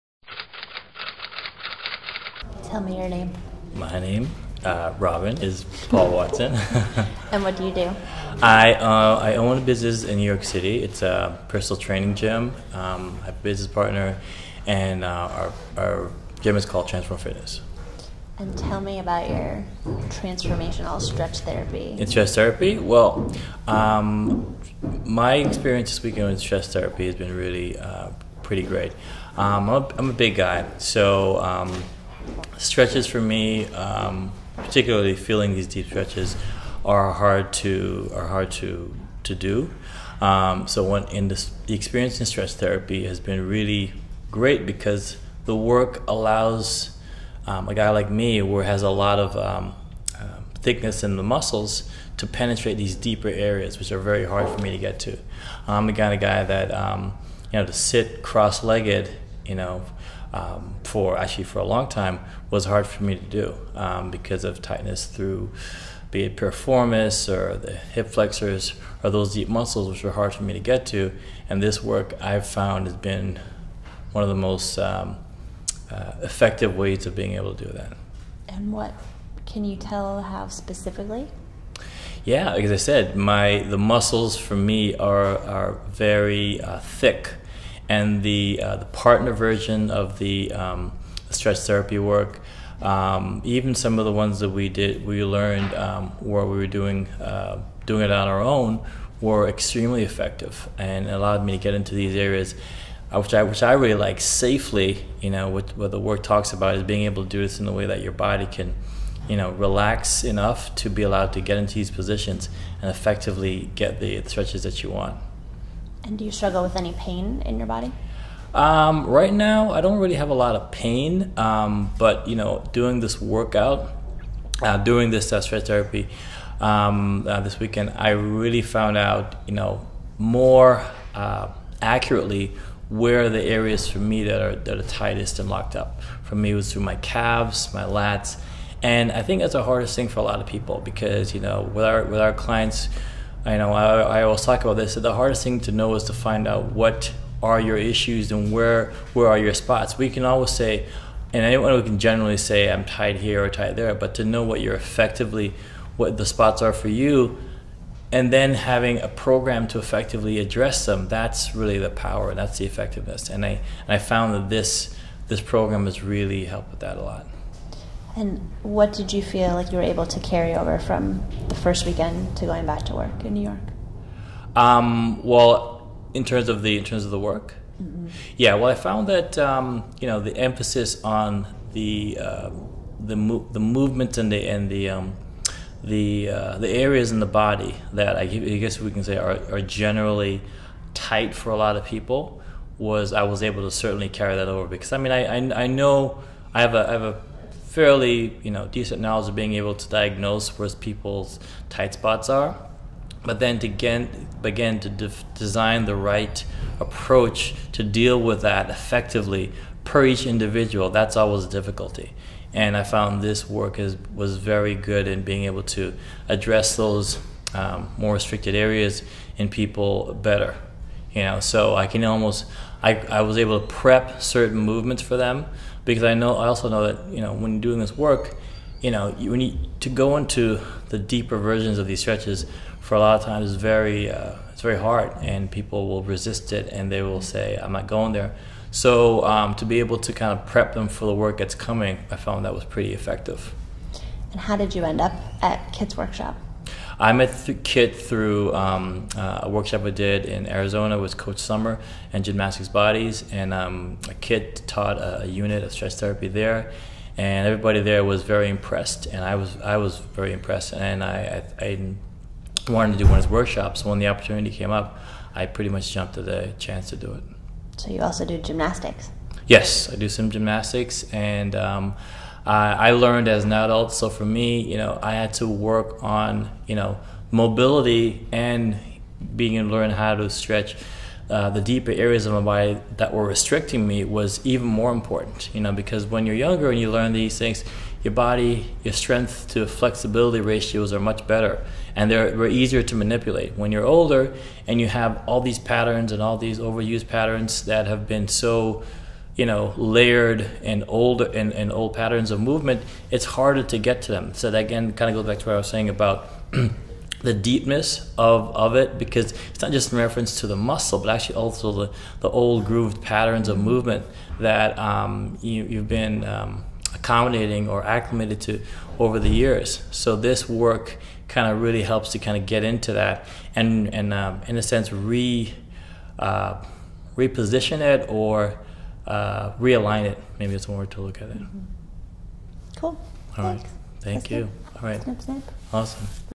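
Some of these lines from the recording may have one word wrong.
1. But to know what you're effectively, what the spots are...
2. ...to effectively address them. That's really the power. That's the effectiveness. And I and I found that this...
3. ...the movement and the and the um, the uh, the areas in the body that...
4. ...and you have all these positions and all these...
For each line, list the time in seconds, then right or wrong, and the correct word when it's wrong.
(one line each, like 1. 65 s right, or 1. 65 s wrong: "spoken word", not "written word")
1. 153 s right
2. 159 s right
3. 183 s right
4. 294 s wrong: "patterns", not "positions".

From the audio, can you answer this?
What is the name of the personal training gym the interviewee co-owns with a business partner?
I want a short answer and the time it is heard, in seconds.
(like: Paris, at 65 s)
Transform Fitness, at 16 s.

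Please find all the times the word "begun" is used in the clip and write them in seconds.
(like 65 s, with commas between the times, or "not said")
not said.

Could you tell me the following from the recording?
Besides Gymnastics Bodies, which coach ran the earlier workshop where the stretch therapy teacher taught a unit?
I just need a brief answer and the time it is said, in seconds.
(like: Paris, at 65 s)
Coach Sommer, at 251 s.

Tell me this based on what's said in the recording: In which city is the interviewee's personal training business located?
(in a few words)
New York City.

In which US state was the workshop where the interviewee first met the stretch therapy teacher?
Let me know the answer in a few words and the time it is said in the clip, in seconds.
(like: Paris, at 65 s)
Arizona, at 250 s.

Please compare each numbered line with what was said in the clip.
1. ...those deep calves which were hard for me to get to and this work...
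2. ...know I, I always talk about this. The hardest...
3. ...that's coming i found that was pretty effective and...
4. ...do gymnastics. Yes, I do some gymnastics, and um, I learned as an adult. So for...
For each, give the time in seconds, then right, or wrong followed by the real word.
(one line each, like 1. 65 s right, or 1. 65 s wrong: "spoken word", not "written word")
1. 69 s wrong: "muscles", not "calves"
2. 143 s right
3. 241 s right
4. 268 s right.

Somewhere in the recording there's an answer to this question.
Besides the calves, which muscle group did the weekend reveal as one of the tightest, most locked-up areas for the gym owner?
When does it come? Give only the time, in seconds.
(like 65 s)
137 s.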